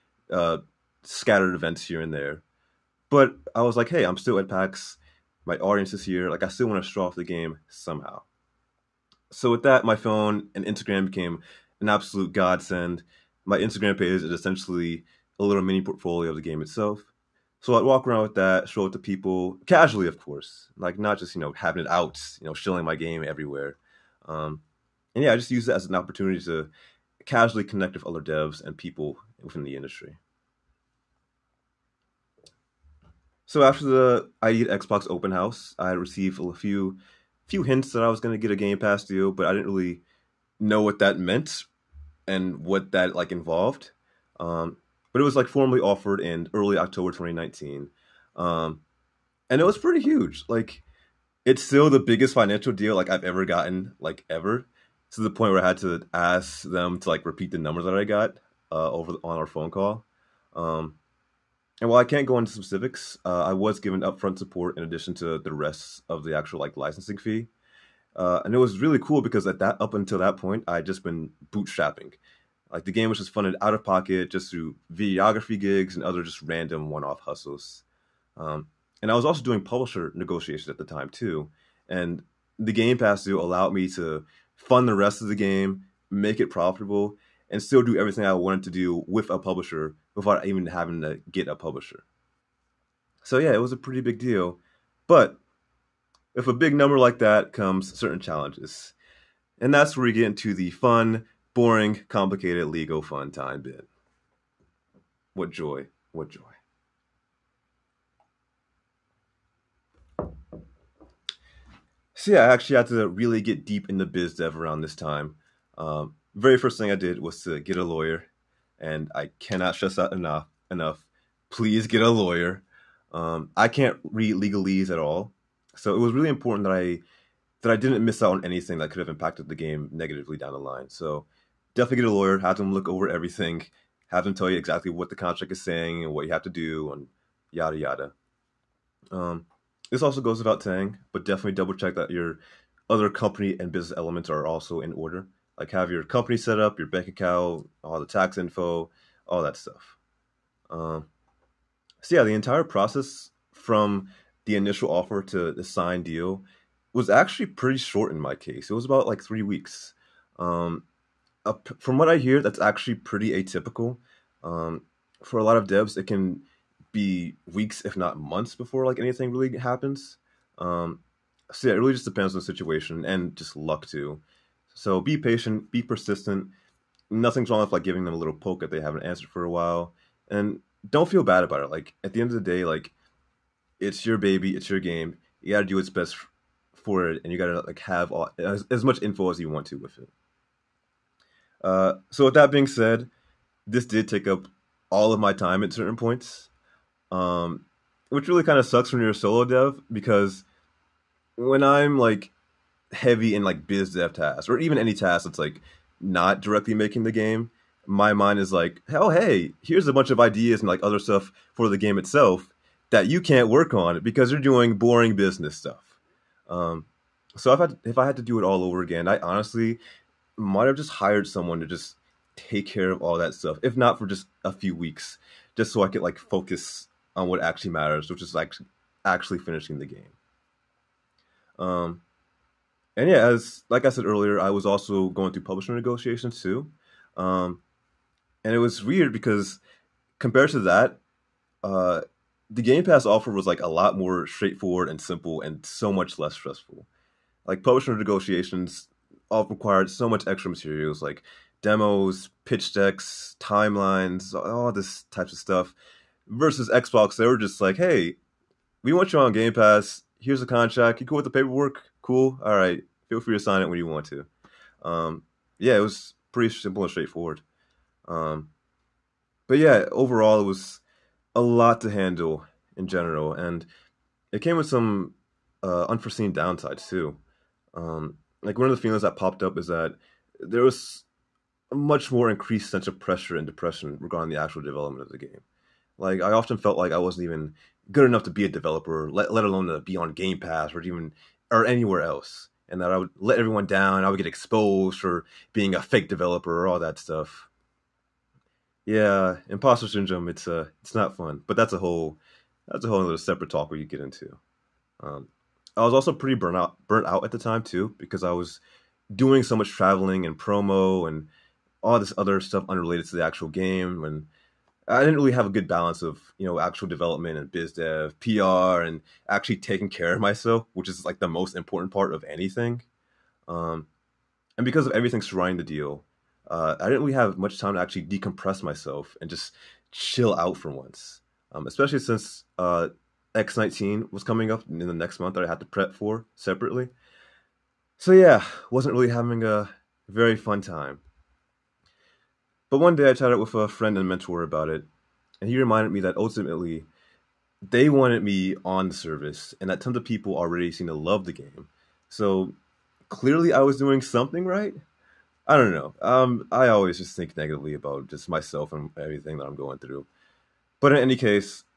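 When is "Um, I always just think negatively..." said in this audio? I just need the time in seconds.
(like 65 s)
356 s.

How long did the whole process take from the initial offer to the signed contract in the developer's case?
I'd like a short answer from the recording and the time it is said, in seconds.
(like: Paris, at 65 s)
About 3 weeks, at 159 s.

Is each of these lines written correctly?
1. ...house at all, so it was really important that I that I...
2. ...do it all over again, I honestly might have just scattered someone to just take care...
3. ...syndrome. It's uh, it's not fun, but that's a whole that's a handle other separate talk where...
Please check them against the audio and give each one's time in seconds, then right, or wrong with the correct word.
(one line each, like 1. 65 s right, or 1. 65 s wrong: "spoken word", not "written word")
1. 124 s wrong: "legalese", not "house"
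2. 218 s wrong: "hired", not "scattered"
3. 299 s wrong: "whole", not "handle".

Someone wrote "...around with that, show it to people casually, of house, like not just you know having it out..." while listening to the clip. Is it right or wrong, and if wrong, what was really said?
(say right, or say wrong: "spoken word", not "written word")
wrong: "course", not "house".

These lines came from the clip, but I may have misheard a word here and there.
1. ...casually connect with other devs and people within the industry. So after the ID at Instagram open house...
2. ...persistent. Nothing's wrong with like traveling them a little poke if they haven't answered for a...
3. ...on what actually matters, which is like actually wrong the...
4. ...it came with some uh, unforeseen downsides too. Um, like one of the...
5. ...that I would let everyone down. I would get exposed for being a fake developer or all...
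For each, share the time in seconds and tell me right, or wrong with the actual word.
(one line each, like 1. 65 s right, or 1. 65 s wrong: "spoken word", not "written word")
1. 27 s wrong: "Xbox", not "Instagram"
2. 175 s wrong: "giving", not "traveling"
3. 227 s wrong: "finishing", not "wrong"
4. 274 s right
5. 292 s right.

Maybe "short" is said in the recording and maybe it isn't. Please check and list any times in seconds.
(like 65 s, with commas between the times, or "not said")
157 s.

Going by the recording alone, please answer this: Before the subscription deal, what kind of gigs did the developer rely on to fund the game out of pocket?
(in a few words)
Videography gigs.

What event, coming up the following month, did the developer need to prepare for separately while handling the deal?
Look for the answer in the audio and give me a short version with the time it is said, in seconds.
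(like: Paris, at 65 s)
X19, at 333 s.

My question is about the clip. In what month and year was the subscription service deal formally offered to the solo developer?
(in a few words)
October 2019.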